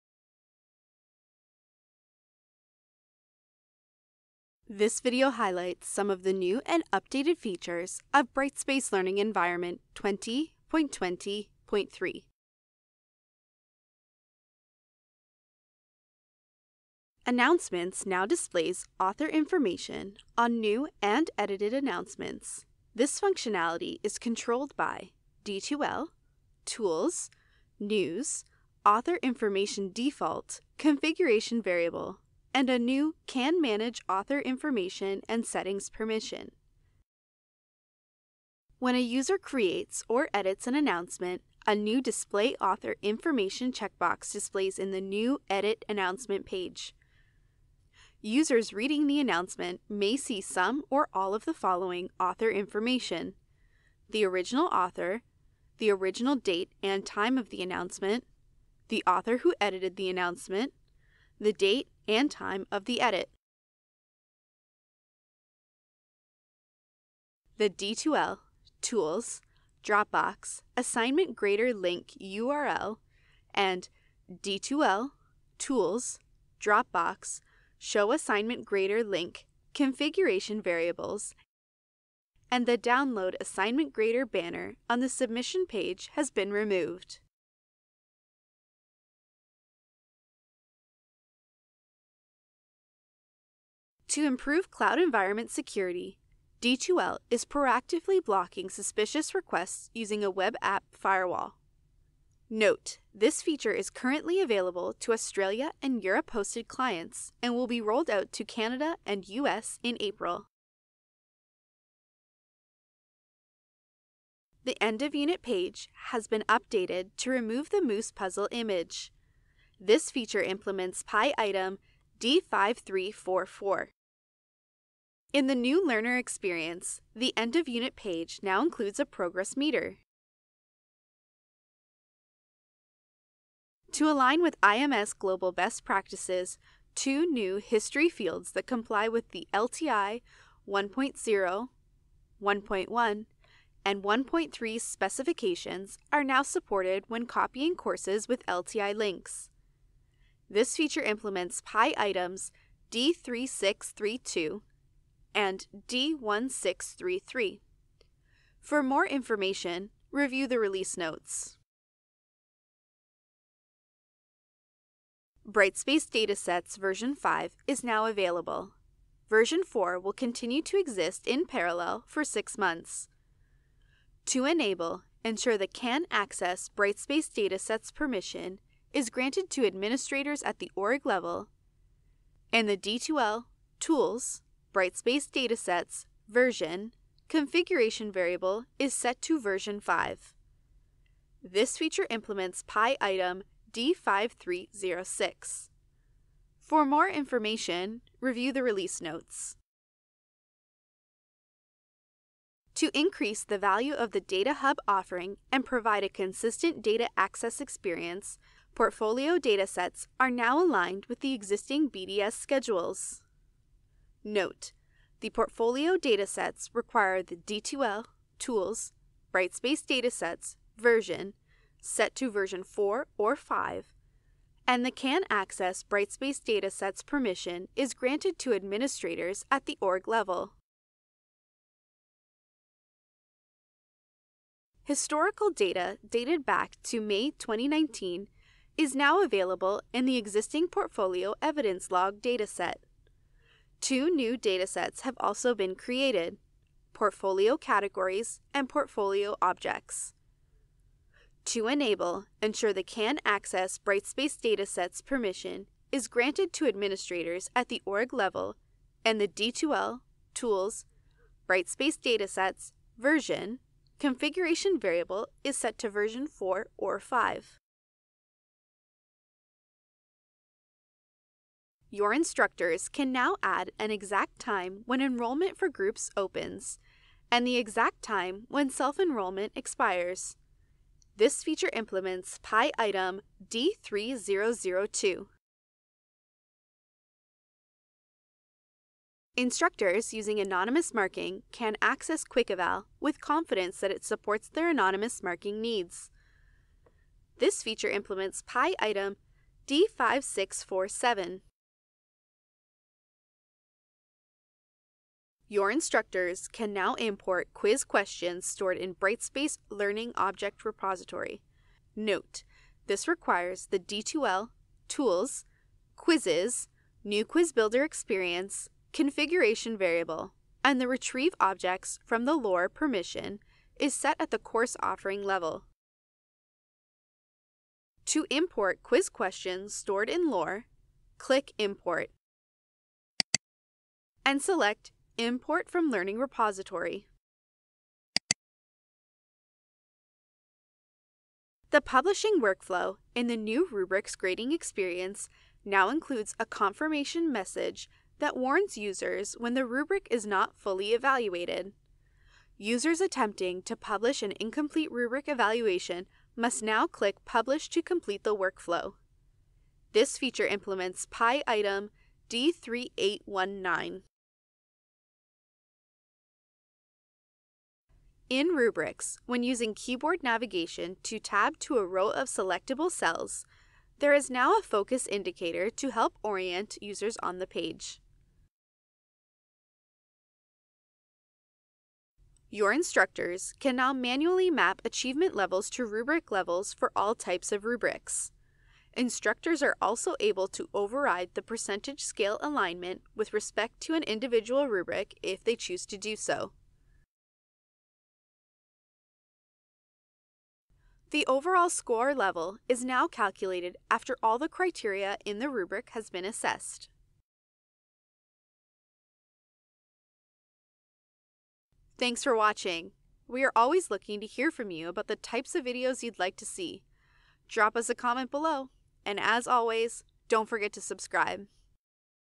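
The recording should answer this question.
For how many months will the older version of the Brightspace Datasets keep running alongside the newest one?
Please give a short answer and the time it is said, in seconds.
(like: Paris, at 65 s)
6, at 172 s.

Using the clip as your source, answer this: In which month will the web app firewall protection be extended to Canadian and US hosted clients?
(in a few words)
April.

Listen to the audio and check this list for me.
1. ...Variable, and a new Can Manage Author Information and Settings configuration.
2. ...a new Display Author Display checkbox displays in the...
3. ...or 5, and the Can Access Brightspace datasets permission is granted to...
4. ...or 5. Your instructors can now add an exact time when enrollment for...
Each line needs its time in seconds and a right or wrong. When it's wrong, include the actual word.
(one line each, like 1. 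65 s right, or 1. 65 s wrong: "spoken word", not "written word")
1. 31 s wrong: "permission", not "configuration"
2. 41 s wrong: "Information", not "Display"
3. 223 s right
4. 266 s right.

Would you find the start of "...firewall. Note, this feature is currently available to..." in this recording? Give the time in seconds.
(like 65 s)
100 s.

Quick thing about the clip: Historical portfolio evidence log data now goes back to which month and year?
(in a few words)
May 2019.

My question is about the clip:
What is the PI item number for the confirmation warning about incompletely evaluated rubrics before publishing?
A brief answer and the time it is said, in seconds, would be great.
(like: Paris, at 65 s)
D3819, at 362 s.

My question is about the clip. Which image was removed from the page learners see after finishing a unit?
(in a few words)
moose puzzle image.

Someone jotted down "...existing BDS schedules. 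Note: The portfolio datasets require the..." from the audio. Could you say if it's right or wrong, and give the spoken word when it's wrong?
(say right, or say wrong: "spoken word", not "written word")
right.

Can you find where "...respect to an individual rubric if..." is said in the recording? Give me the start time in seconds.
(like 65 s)
393 s.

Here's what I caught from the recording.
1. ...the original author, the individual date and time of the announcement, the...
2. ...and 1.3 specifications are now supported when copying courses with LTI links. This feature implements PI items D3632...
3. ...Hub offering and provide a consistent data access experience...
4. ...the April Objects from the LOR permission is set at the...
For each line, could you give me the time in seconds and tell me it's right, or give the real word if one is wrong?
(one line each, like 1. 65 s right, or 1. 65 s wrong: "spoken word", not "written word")
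1. 54 s wrong: "original", not "individual"
2. 143 s right
3. 204 s right
4. 320 s wrong: "Retrieve", not "April".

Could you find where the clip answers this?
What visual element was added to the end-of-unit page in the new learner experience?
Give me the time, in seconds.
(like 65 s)
129 s.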